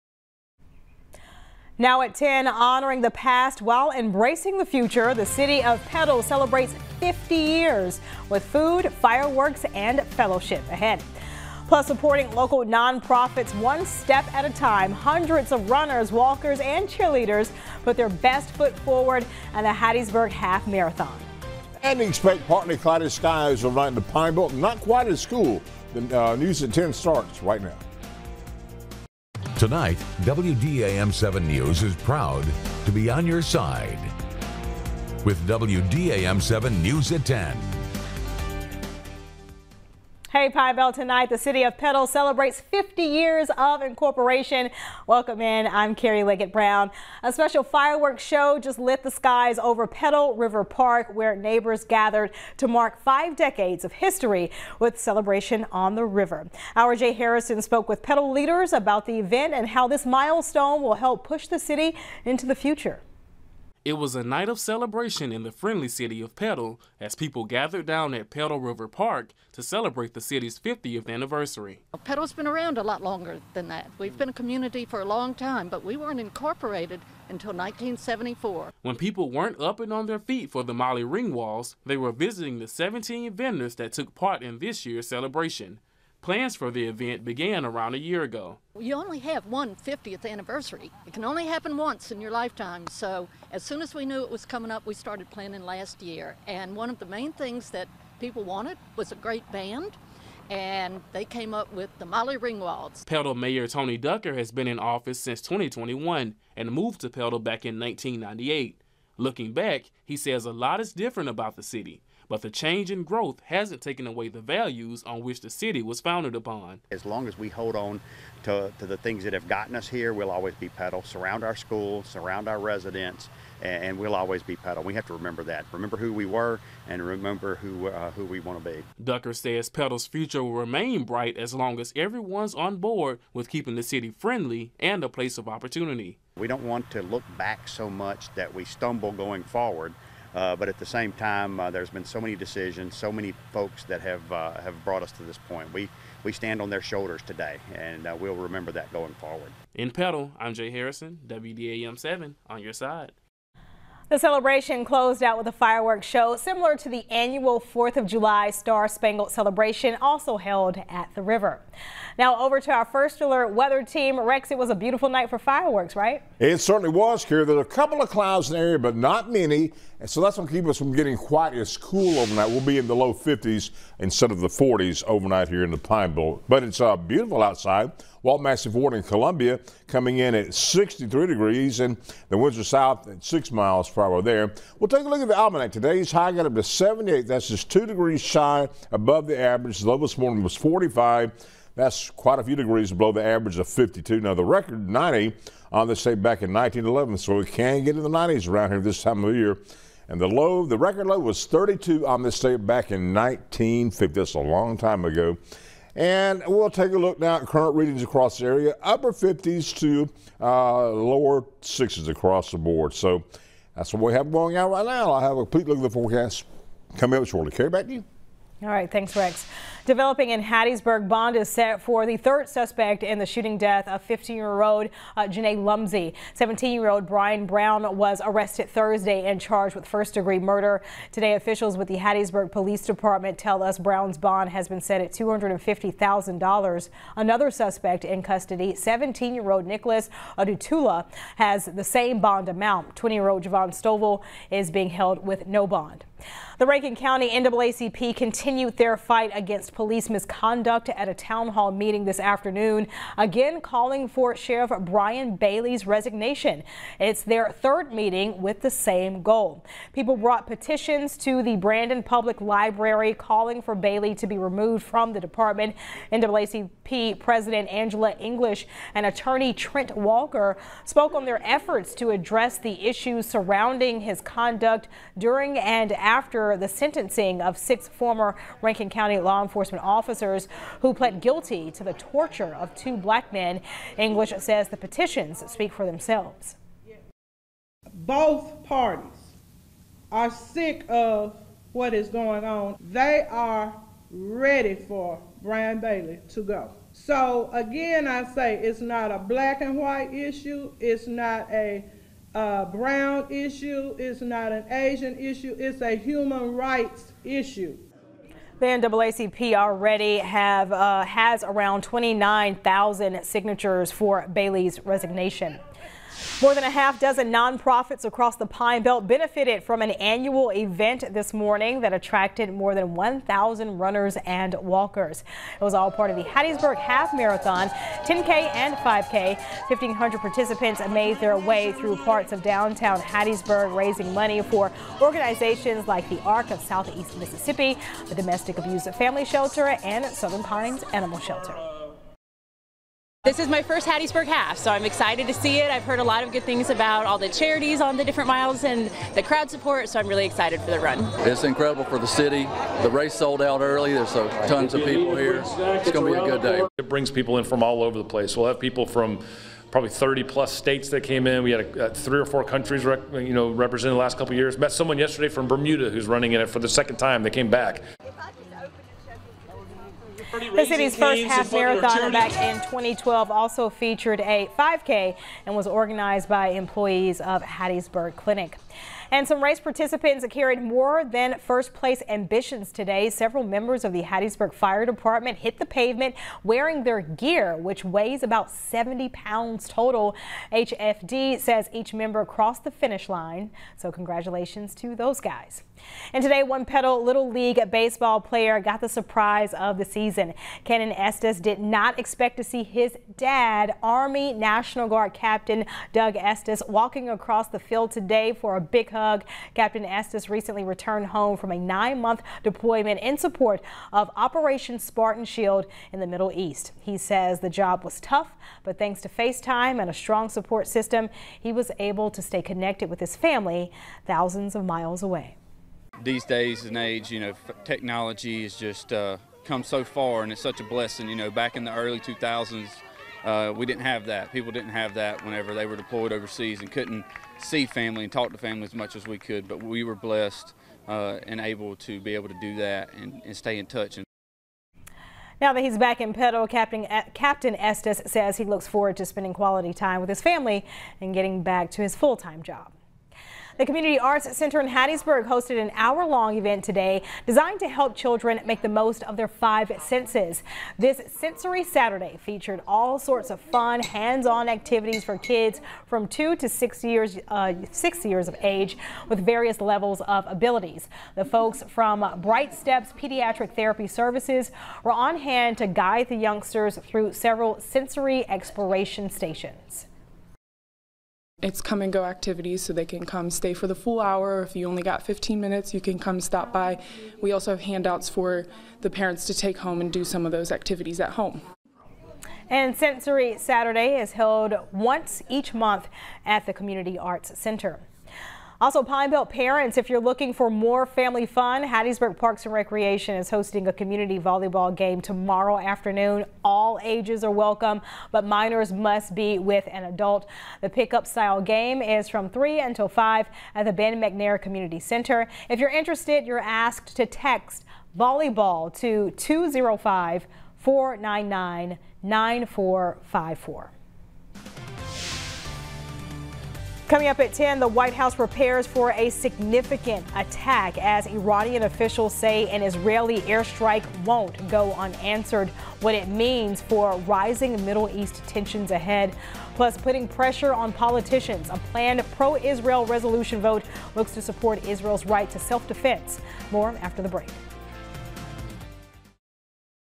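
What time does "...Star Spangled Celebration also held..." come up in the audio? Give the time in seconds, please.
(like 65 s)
158 s.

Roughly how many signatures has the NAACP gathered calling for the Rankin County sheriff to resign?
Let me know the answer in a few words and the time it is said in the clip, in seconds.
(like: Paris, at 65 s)
29,000, at 311 s.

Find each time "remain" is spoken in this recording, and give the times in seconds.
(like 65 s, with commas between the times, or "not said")
130 s.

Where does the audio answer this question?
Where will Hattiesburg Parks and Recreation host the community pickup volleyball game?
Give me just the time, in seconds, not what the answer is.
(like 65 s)
513 s.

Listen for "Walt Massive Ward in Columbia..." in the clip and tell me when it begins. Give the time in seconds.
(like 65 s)
178 s.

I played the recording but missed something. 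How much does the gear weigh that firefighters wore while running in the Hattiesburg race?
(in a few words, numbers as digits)
70 pounds.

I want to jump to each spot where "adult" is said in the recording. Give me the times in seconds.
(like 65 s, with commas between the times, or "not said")
509 s.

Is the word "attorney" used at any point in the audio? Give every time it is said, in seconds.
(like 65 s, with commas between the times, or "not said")
269 s.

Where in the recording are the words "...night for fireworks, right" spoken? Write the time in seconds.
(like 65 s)
165 s.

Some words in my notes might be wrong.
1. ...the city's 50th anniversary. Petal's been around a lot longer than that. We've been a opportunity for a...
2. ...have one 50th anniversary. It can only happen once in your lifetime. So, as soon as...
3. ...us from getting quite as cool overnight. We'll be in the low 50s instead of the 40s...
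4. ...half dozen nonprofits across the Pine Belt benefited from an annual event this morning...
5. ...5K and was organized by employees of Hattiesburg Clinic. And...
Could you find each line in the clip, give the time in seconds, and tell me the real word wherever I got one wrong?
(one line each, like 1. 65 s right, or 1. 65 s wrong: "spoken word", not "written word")
1. 70 s wrong: "community", not "opportunity"
2. 89 s right
3. 170 s right
4. 316 s right
5. 374 s right.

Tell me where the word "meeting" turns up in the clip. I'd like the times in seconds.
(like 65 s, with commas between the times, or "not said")
251 s, 257 s.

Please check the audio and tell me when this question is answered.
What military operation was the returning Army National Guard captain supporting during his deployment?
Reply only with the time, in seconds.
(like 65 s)
414 s.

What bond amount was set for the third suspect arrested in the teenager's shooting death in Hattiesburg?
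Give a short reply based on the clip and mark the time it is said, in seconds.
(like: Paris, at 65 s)
$250,000, at 235 s.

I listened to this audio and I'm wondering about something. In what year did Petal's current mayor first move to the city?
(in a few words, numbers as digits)
1998.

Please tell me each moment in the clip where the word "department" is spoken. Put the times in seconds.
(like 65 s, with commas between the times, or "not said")
232 s, 265 s, 384 s.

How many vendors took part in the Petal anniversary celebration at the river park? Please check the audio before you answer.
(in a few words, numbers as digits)
17.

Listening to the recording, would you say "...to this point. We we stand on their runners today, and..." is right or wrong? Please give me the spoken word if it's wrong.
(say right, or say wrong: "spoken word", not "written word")
wrong: "shoulders", not "runners".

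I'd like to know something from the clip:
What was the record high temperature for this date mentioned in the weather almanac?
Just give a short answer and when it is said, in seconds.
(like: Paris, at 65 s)
90, at 194 s.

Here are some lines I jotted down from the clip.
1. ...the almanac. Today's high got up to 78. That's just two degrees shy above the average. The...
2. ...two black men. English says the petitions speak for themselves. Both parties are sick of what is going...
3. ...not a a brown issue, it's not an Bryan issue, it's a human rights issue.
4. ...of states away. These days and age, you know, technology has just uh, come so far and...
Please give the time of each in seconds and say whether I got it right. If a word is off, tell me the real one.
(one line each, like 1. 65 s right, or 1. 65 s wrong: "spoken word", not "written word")
1. 185 s right
2. 282 s right
3. 301 s wrong: "Asian", not "Bryan"
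4. 424 s wrong: "miles", not "states".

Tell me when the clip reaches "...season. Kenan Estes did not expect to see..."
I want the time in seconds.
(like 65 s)
399 s.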